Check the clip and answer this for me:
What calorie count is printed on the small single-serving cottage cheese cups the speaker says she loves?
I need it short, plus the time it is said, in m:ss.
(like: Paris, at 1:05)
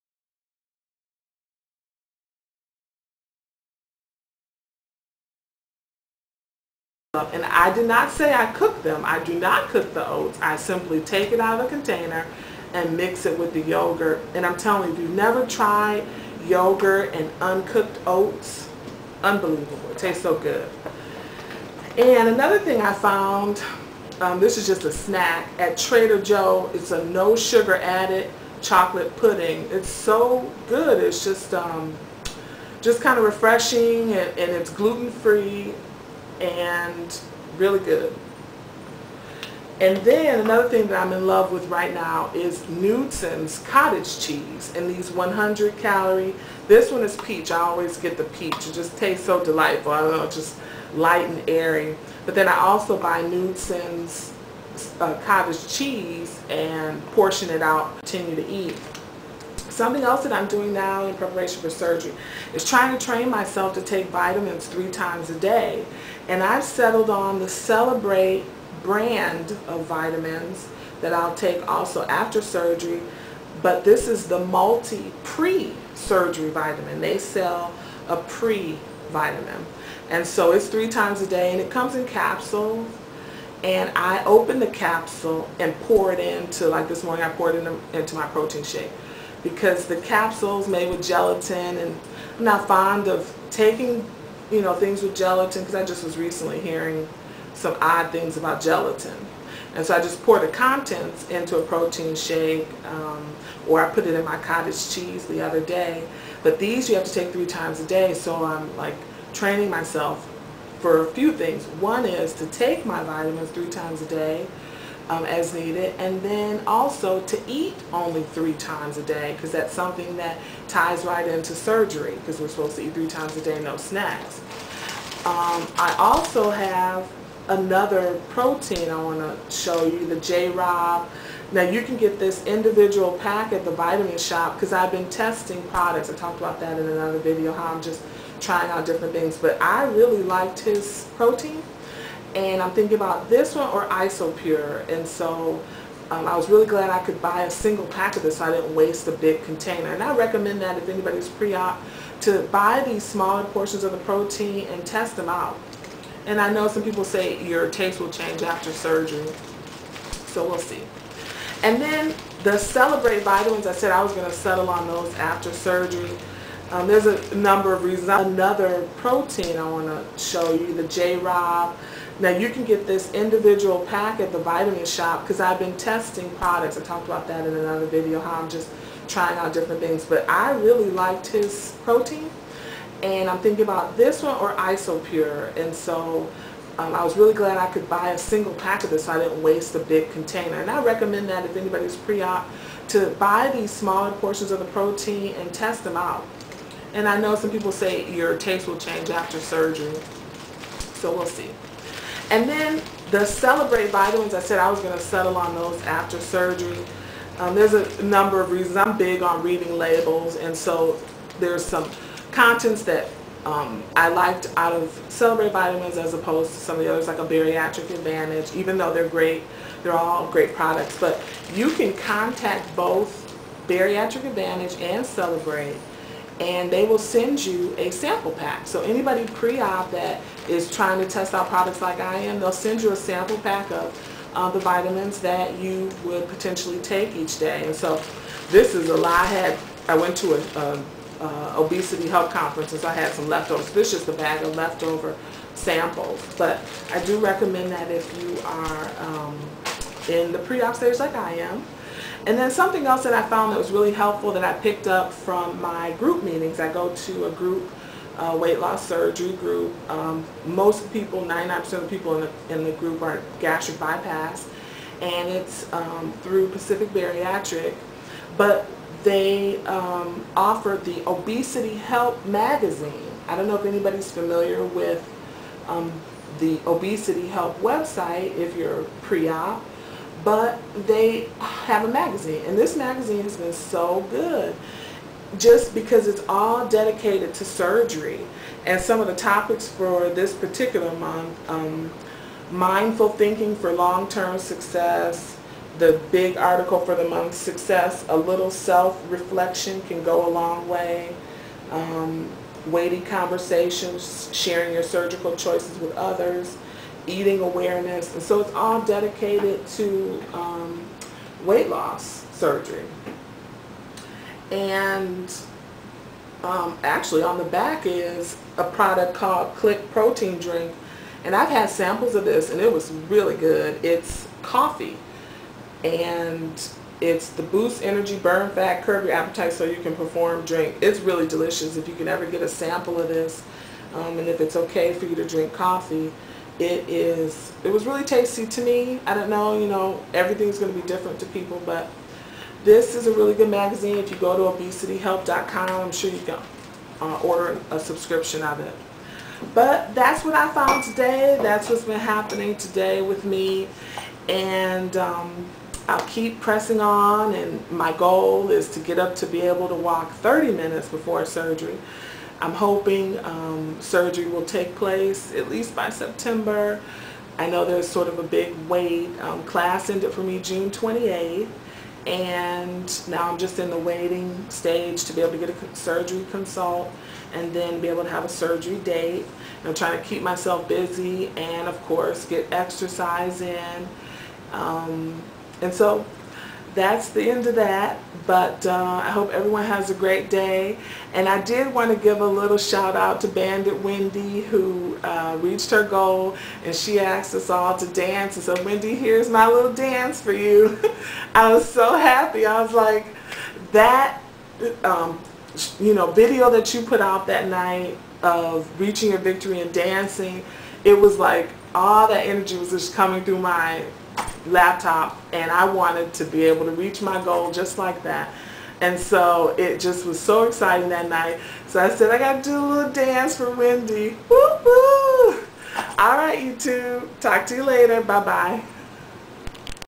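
100, at 0:45.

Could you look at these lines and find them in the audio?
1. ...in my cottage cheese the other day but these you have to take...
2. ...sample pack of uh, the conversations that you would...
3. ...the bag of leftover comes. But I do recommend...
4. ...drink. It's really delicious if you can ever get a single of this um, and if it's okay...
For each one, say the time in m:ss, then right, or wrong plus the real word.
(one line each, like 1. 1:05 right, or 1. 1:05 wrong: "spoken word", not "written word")
1. 1:44 right
2. 3:52 wrong: "vitamins", not "conversations"
3. 4:04 wrong: "samples", not "comes"
4. 5:30 wrong: "sample", not "single".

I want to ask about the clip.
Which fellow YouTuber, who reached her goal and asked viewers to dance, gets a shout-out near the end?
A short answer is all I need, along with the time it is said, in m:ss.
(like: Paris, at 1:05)
Banded Wendy, at 6:33.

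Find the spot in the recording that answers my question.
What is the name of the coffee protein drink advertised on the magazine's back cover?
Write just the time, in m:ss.
5:19.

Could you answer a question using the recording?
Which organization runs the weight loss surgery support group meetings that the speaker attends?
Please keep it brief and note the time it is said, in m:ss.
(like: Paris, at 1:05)
Pacific Bariatric, at 4:26.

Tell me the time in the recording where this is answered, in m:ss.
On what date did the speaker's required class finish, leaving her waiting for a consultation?
6:10.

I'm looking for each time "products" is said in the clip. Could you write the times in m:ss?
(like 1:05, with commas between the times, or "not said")
2:15, 2:56, 3:40, 3:51, 5:18.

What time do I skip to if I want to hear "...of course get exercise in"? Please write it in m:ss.
6:21.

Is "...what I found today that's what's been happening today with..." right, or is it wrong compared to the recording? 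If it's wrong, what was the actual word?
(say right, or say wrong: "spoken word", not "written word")
right.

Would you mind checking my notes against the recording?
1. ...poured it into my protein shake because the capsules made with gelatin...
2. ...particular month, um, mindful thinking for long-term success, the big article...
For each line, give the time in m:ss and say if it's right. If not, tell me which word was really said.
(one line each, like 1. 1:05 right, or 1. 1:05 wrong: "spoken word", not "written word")
1. 1:27 right
2. 4:50 right.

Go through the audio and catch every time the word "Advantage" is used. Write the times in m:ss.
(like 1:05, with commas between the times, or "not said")
3:37, 3:44.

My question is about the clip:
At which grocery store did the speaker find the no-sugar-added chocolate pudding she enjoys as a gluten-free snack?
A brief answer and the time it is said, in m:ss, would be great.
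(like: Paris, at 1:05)
Trader Joe's, at 0:25.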